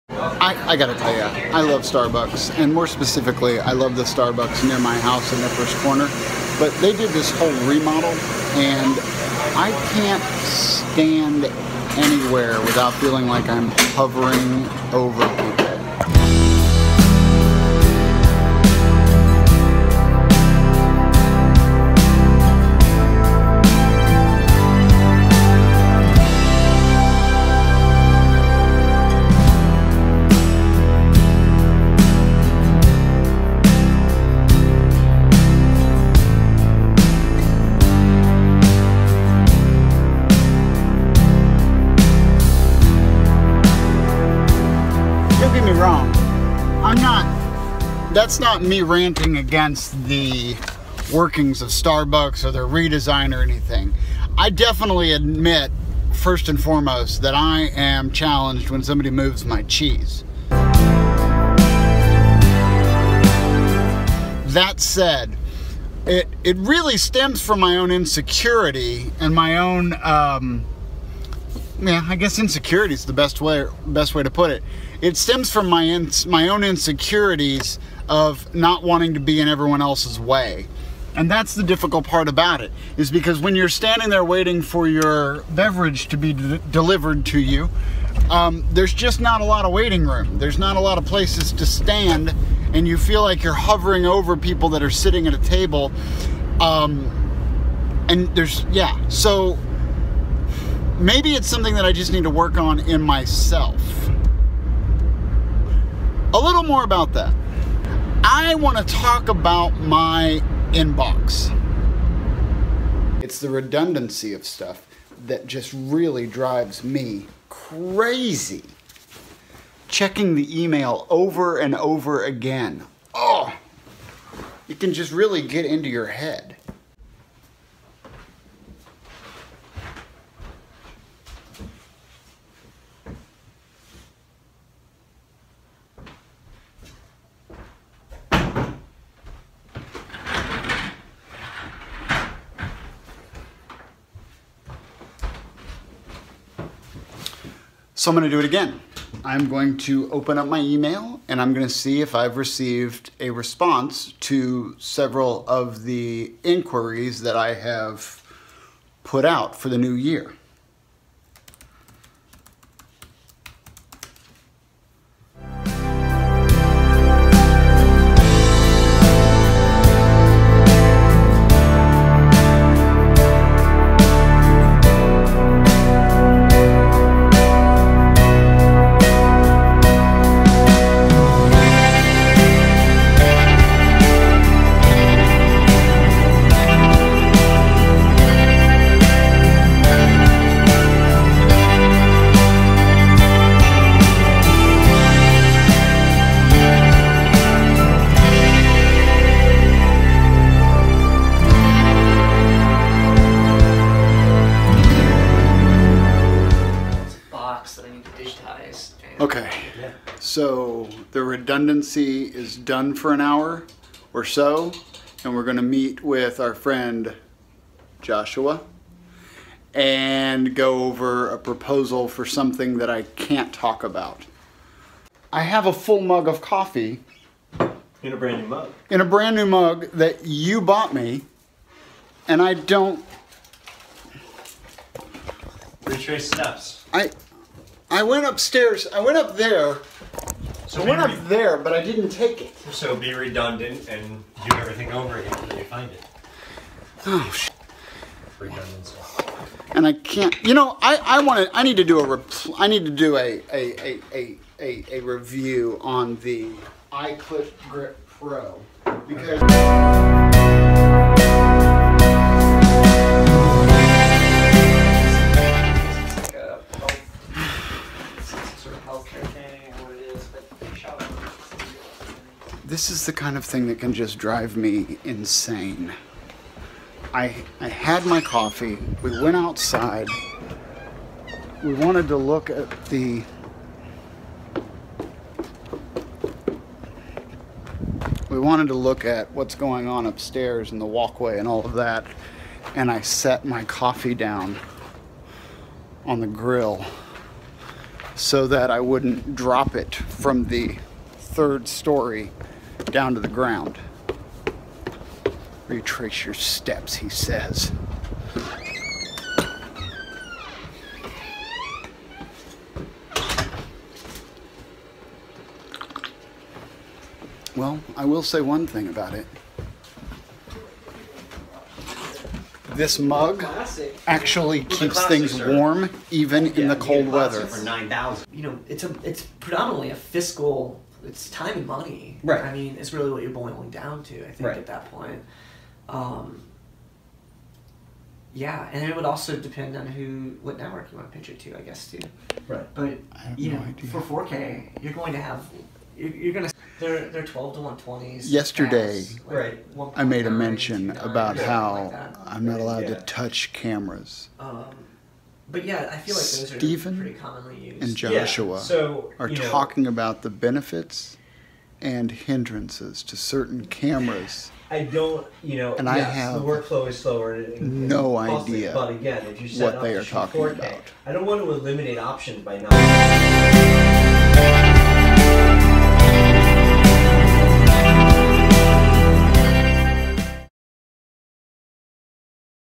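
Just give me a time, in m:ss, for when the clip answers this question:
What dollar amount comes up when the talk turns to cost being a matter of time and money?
5:27.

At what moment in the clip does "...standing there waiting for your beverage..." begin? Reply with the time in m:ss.
1:23.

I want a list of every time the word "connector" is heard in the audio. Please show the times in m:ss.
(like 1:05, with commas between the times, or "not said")
not said.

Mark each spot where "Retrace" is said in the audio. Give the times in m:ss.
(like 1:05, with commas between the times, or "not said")
3:55, 5:05.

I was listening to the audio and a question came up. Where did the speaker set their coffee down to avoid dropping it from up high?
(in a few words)
On the grill.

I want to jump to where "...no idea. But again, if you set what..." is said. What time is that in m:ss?
6:07.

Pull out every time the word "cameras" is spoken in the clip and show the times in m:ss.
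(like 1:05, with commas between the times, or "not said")
5:53, 6:03.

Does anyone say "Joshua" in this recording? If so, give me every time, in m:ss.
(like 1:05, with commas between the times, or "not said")
3:38, 5:57.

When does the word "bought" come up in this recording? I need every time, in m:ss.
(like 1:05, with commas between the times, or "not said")
3:50.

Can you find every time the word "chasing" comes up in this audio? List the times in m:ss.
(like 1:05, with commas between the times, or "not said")
not said.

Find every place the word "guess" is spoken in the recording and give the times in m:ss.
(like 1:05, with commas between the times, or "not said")
1:12, 5:41.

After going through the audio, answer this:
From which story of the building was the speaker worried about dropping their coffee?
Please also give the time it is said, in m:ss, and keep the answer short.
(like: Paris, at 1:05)
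Third story, at 5:01.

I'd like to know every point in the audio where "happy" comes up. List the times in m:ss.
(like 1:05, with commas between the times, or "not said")
not said.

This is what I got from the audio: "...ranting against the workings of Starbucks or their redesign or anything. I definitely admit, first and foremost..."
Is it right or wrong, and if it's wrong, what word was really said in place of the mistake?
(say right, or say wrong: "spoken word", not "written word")
right.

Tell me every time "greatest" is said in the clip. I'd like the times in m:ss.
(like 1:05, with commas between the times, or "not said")
not said.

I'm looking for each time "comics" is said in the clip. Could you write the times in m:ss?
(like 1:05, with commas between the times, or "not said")
not said.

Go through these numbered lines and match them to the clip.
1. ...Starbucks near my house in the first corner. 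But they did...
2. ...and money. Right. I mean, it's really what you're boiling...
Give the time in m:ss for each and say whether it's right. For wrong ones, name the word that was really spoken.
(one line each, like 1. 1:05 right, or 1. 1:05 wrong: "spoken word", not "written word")
1. 0:04 right
2. 5:31 right.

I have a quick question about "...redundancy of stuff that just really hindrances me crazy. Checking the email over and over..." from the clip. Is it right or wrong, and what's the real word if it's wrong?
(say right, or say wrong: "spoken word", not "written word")
wrong: "drives", not "hindrances".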